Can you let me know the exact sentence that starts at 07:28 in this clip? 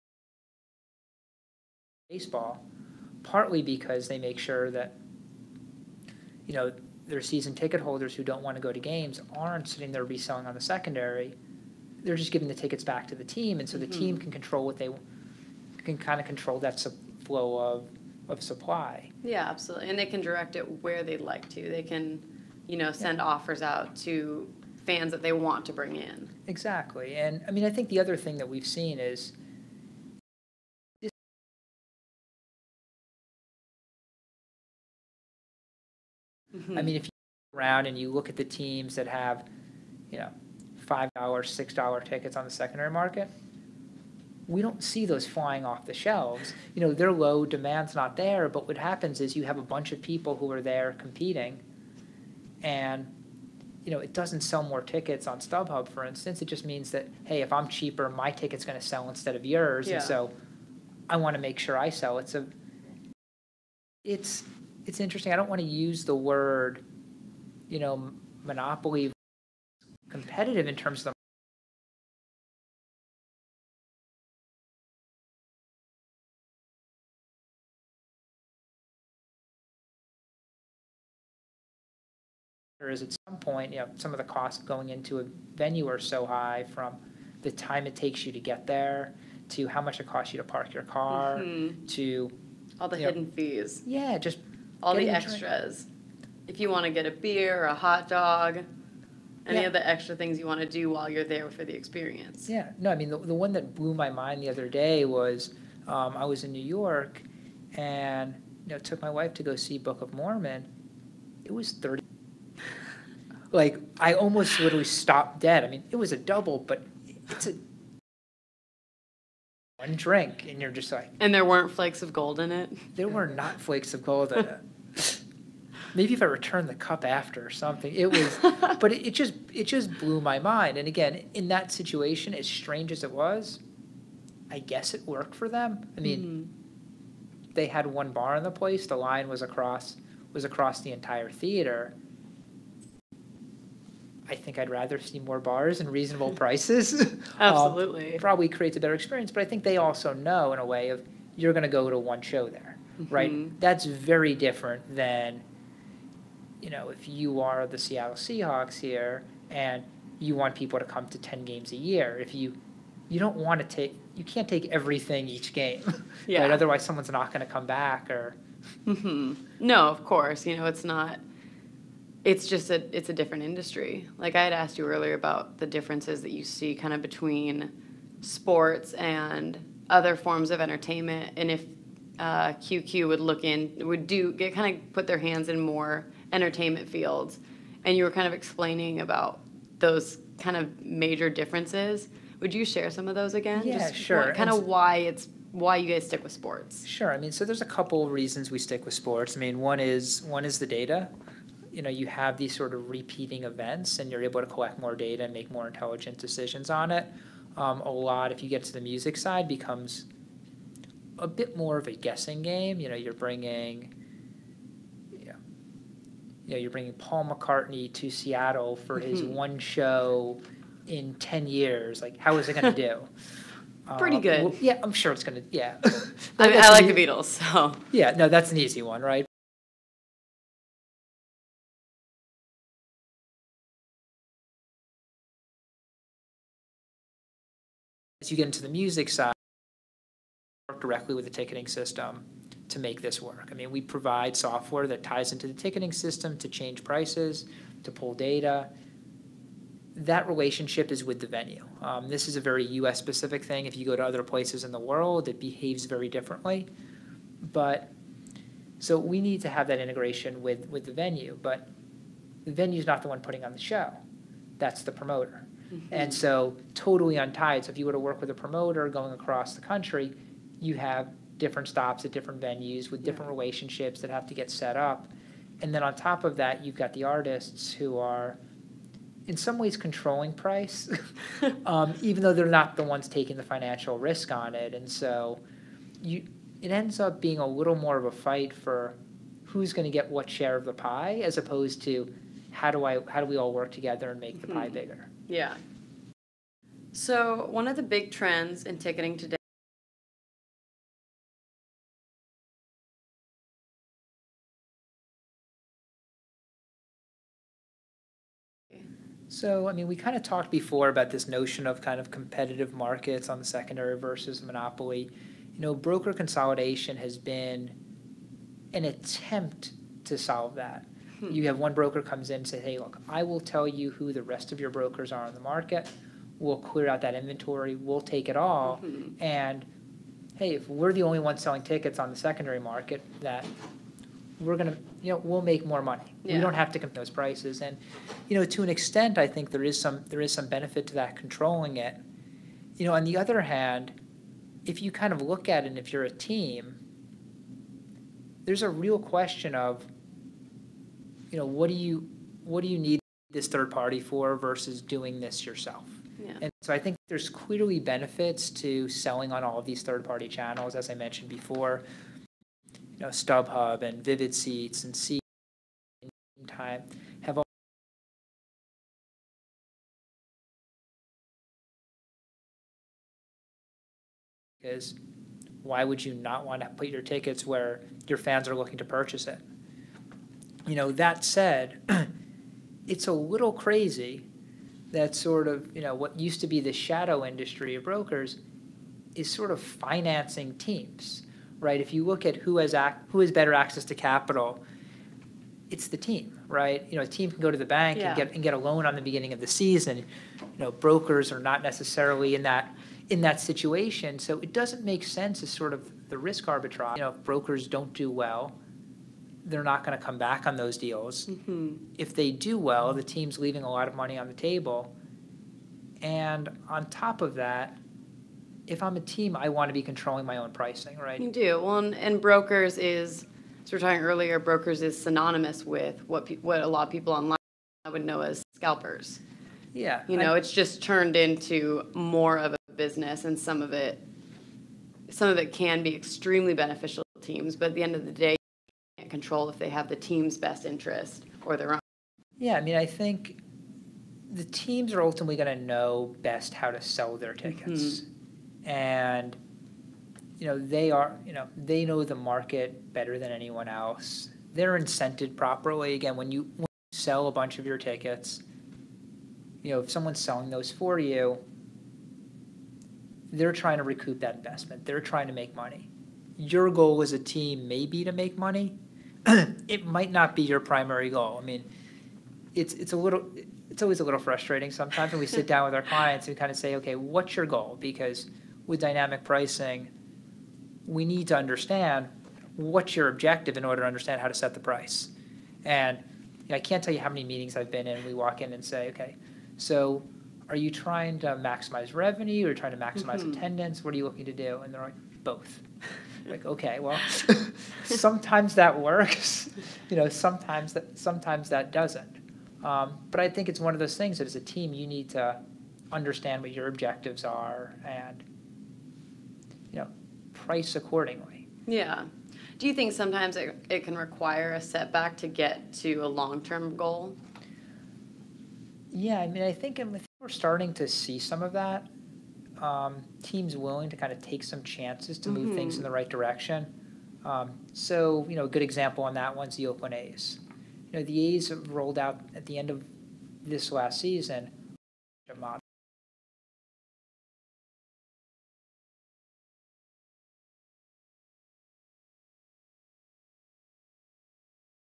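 Mm-hmm and you know they are you know they know the market better than anyone else.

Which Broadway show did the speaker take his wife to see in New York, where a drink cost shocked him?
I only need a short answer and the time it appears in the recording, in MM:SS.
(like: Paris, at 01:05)
Book of Mormon, at 01:49.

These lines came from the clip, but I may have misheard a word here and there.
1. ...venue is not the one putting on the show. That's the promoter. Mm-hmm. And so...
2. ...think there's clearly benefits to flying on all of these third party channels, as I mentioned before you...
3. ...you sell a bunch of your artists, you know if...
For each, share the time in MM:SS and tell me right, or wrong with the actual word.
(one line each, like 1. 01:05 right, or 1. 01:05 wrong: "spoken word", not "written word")
1. 04:22 right
2. 05:56 wrong: "selling", not "flying"
3. 07:36 wrong: "tickets", not "artists".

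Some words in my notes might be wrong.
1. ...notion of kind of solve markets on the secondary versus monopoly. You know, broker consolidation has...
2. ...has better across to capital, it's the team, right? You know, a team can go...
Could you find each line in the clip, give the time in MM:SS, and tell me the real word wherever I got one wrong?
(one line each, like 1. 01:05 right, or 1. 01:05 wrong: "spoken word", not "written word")
1. 05:11 wrong: "competitive", not "solve"
2. 06:33 wrong: "access", not "across".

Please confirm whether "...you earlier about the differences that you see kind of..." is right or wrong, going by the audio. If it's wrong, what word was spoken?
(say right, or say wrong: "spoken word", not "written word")
right.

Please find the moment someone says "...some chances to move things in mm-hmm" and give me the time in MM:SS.
08:44.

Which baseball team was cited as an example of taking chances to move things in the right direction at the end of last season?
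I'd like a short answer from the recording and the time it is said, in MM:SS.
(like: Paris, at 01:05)
Oakland A's, at 08:49.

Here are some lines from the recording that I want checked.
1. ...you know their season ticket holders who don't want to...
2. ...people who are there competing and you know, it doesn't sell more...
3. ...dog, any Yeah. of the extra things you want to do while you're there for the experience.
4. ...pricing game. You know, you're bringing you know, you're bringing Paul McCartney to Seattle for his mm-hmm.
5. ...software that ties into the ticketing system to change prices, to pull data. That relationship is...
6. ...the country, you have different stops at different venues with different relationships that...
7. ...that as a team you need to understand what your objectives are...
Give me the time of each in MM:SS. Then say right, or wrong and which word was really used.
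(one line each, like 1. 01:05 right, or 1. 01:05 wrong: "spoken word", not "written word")
1. 00:06 right
2. 00:50 right
3. 01:38 right
4. 03:31 wrong: "guessing", not "pricing"
5. 04:04 right
6. 04:29 right
7. 08:24 right.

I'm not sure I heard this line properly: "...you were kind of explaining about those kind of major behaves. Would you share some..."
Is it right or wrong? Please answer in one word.
wrong.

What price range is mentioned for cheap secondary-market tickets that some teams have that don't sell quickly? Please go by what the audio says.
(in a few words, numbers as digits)
$5, $6.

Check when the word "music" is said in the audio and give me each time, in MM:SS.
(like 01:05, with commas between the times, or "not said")
03:28, 03:58.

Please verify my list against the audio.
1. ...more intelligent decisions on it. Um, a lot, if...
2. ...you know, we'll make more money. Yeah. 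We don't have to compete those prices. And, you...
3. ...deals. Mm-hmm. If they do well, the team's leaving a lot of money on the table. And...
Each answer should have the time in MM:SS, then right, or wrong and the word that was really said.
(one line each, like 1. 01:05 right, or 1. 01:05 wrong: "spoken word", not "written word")
1. 03:25 right
2. 05:35 right
3. 06:50 right.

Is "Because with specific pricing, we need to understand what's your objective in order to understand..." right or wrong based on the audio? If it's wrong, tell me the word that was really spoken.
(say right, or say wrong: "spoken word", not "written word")
wrong: "dynamic", not "specific".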